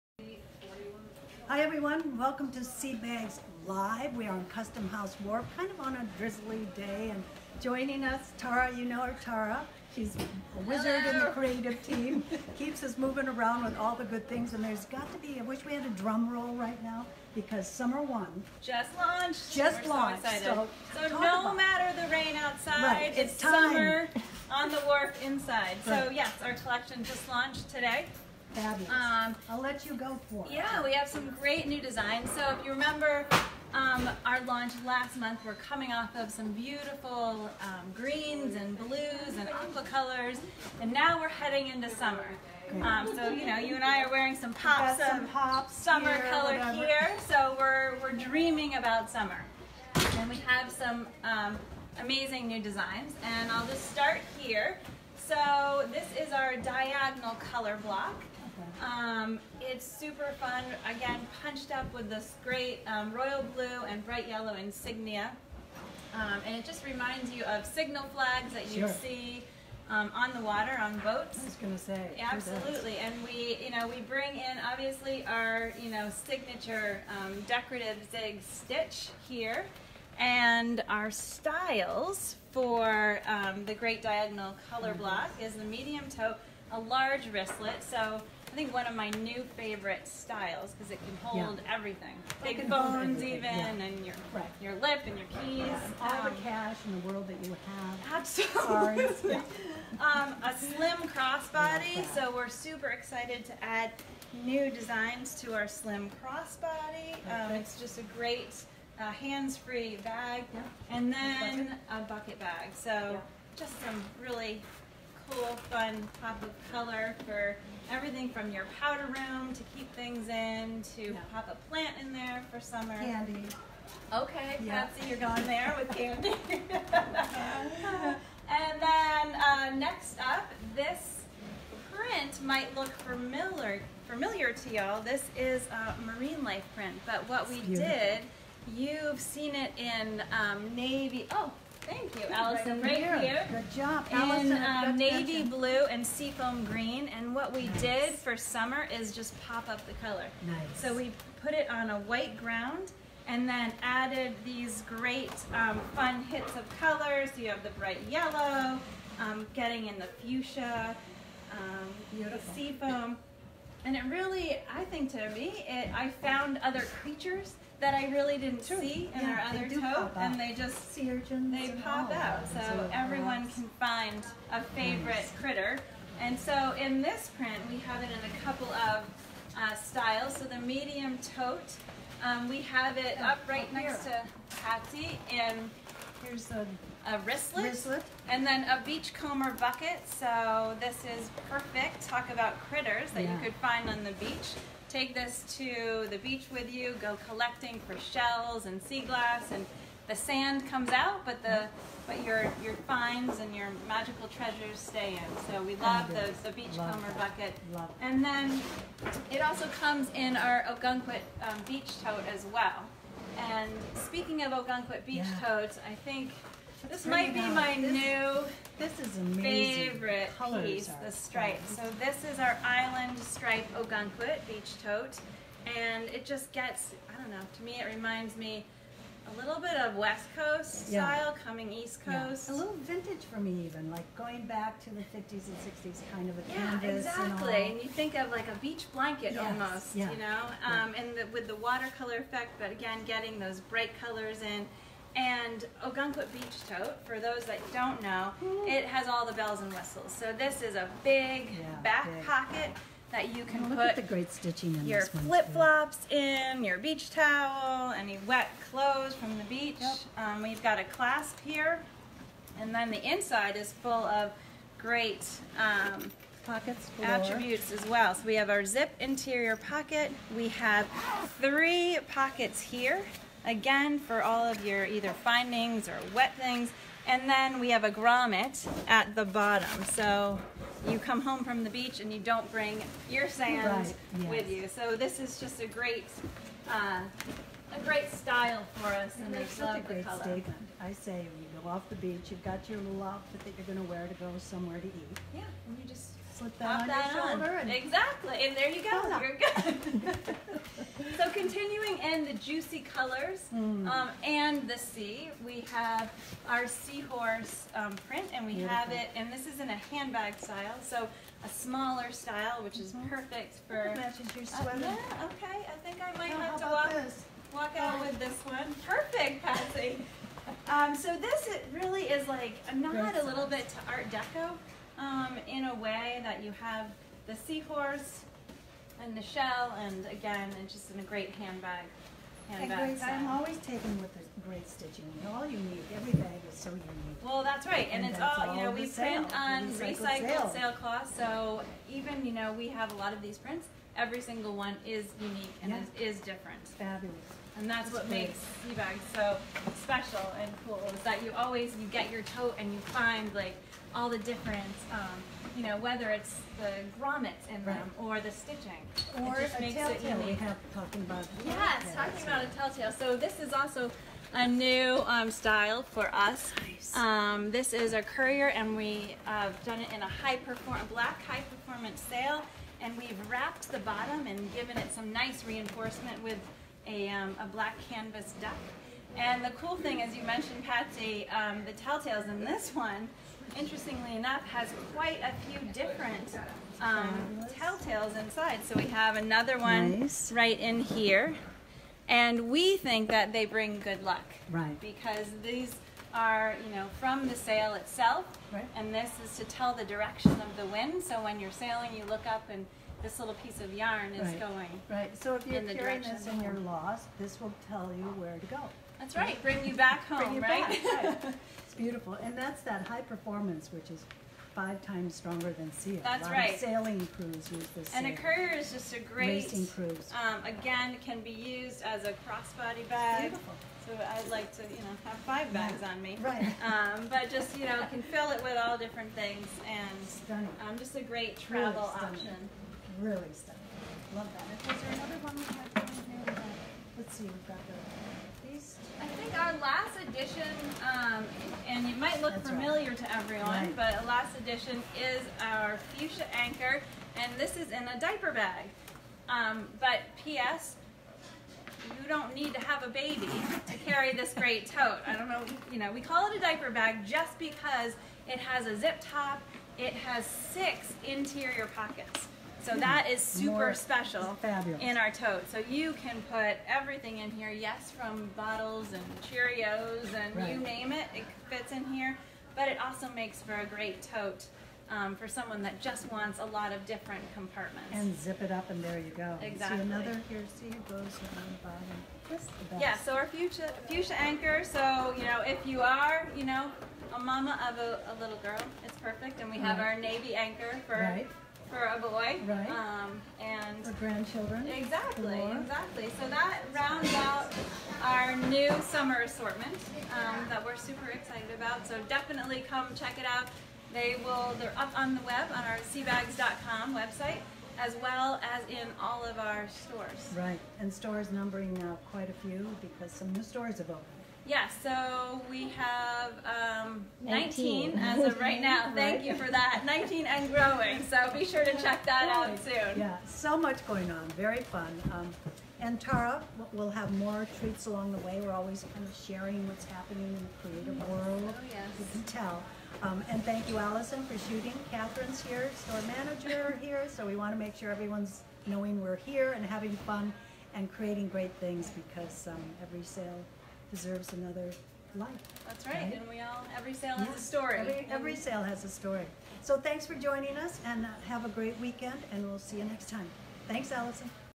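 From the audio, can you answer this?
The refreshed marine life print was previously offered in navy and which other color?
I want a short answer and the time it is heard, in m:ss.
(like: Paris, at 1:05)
seafoam green, at 2:26.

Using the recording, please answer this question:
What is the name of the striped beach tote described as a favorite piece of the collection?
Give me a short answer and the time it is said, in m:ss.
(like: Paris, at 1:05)
island stripe, at 3:42.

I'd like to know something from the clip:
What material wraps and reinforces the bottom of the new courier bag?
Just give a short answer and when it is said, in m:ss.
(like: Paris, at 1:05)
black canvas duck, at 6:17.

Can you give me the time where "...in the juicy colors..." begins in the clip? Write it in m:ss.
5:01.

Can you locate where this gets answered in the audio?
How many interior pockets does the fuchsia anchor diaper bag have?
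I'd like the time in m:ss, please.
7:40.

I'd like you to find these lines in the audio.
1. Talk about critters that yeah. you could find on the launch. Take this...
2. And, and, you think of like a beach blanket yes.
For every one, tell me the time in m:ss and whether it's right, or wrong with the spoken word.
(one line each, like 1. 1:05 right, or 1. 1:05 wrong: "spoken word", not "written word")
1. 3:12 wrong: "beach", not "launch"
2. 3:57 right.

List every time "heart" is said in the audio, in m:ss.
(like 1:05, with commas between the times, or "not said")
not said.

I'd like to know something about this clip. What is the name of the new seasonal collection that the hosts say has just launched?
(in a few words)
Summer 1.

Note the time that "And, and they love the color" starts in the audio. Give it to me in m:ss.
4:49.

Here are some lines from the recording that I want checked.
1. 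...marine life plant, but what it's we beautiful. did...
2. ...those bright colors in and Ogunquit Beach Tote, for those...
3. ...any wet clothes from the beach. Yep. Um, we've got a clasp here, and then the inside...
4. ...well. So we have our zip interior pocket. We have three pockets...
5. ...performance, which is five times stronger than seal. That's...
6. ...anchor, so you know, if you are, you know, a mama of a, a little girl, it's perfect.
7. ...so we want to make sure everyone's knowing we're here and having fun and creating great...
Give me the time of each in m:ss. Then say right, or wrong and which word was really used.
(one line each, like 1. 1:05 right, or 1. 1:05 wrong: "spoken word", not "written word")
1. 2:16 wrong: "print", not "plant"
2. 4:03 right
3. 4:17 right
4. 4:27 right
5. 6:52 right
6. 8:04 right
7. 8:57 right.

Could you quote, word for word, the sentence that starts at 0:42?
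Um, so you know, you and I are wearing some pops of some pops summer here, color whatever.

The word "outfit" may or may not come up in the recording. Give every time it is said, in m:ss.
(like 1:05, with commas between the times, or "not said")
4:53.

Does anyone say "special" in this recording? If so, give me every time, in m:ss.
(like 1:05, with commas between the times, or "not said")
5:49, 7:43.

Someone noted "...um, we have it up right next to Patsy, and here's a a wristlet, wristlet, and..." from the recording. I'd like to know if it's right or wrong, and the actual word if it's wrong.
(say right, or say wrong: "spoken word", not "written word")
right.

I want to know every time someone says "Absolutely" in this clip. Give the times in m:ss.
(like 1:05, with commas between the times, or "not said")
1:12, 1:38.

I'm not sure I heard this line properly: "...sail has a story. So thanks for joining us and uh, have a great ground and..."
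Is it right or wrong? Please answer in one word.
wrong.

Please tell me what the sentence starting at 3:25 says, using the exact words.
So we oh, love the, the beachcomber bucket.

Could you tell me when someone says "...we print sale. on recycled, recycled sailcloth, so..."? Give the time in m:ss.
5:38.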